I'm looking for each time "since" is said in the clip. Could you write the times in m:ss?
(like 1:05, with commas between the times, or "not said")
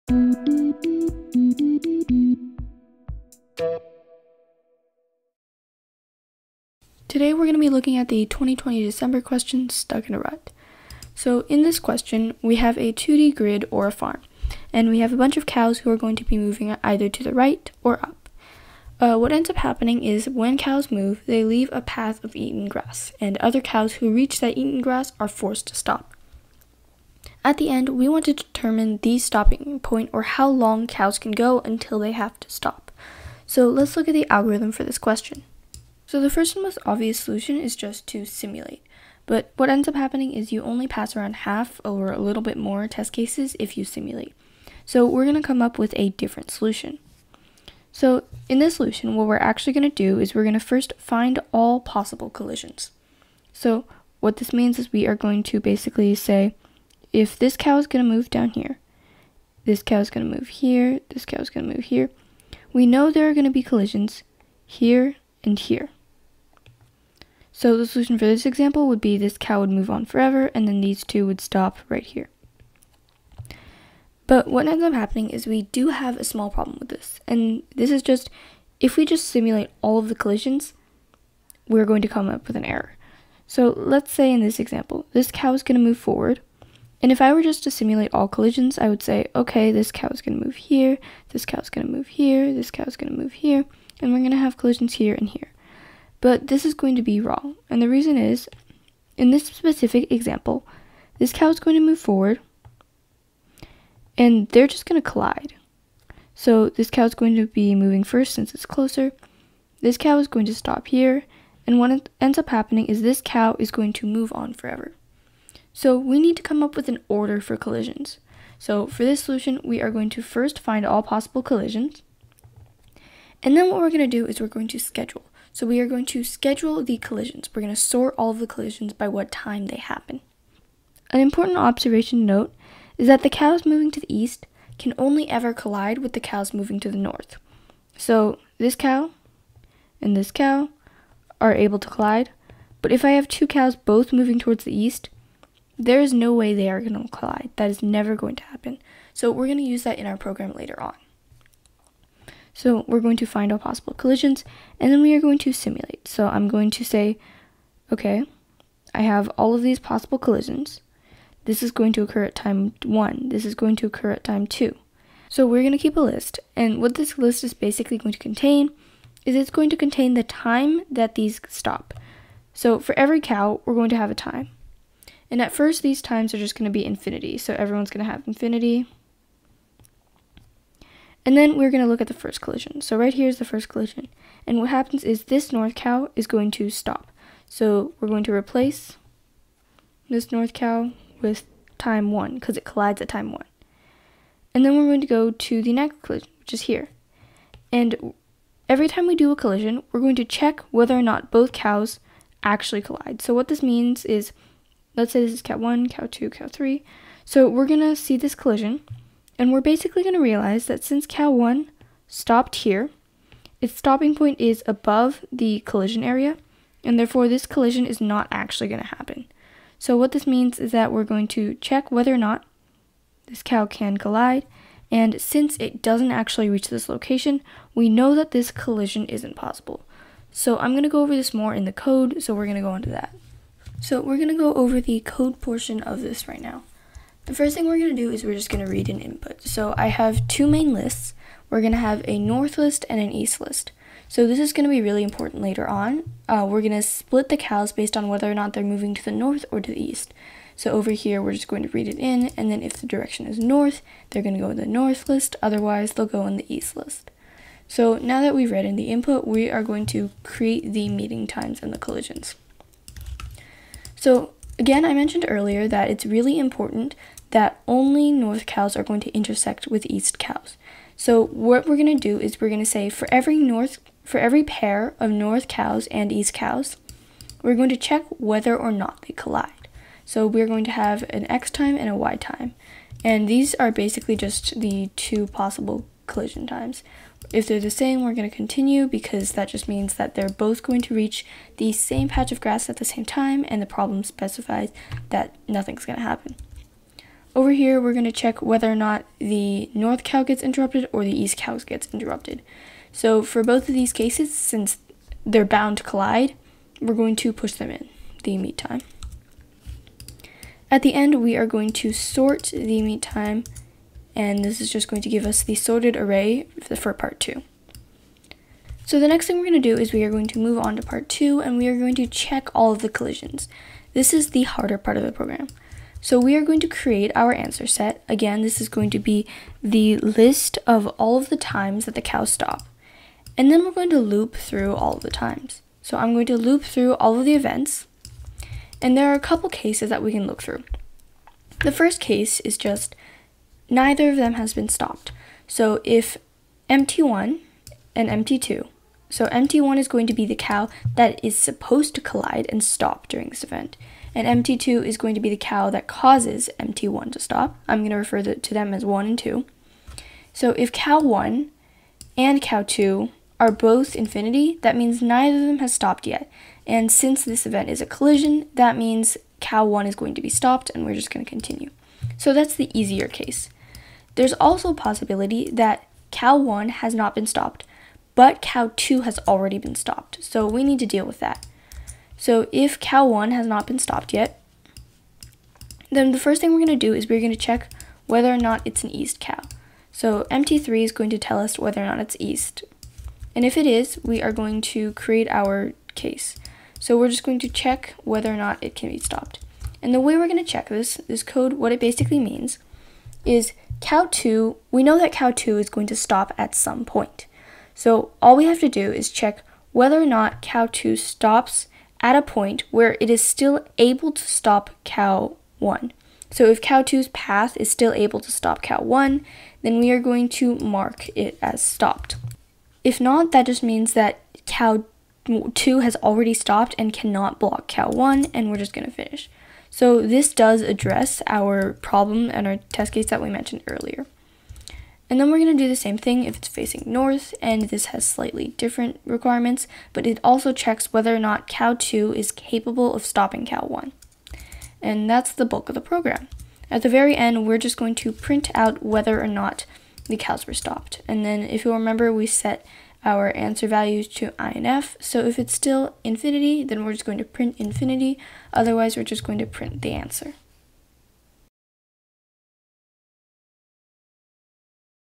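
1:48, 3:30, 3:45, 5:04, 6:06.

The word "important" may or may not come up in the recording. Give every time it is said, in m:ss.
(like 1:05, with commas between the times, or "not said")
2:11, 4:05, 4:26.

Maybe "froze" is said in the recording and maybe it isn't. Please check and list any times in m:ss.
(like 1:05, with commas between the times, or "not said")
not said.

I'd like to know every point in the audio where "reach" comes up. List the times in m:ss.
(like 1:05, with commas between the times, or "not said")
0:24, 3:46, 4:50.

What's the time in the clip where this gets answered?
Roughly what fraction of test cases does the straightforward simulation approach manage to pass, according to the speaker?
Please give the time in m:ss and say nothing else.
0:41.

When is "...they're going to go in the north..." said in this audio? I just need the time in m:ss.
4:14.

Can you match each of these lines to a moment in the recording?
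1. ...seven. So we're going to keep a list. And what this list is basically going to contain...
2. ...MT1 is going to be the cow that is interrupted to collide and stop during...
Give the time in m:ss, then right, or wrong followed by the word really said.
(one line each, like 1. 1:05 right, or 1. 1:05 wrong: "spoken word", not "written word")
1. 2:44 wrong: "two", not "seven"
2. 5:49 wrong: "supposed", not "interrupted".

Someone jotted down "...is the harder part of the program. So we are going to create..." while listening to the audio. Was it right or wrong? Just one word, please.
right.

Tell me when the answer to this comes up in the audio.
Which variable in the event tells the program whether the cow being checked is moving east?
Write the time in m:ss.
6:30.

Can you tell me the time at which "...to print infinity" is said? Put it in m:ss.
7:37.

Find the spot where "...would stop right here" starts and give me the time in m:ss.
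1:11.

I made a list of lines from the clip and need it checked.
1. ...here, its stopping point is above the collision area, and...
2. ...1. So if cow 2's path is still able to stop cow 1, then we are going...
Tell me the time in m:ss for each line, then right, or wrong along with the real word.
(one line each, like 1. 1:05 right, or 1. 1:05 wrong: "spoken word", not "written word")
1. 3:32 right
2. 6:55 right.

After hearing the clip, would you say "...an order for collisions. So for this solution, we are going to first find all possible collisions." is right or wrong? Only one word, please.
right.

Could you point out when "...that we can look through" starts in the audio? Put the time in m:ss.
5:39.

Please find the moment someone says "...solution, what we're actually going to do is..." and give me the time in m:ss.
0:48.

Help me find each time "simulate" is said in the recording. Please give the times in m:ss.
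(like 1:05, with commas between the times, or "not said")
0:38, 0:43, 1:19, 1:27, 2:35.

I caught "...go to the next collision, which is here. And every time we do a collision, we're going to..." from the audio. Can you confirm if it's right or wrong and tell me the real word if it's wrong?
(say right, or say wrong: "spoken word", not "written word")
right.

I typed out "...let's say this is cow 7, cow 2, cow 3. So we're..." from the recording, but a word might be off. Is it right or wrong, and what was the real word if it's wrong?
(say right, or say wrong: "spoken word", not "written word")
wrong: "1", not "7".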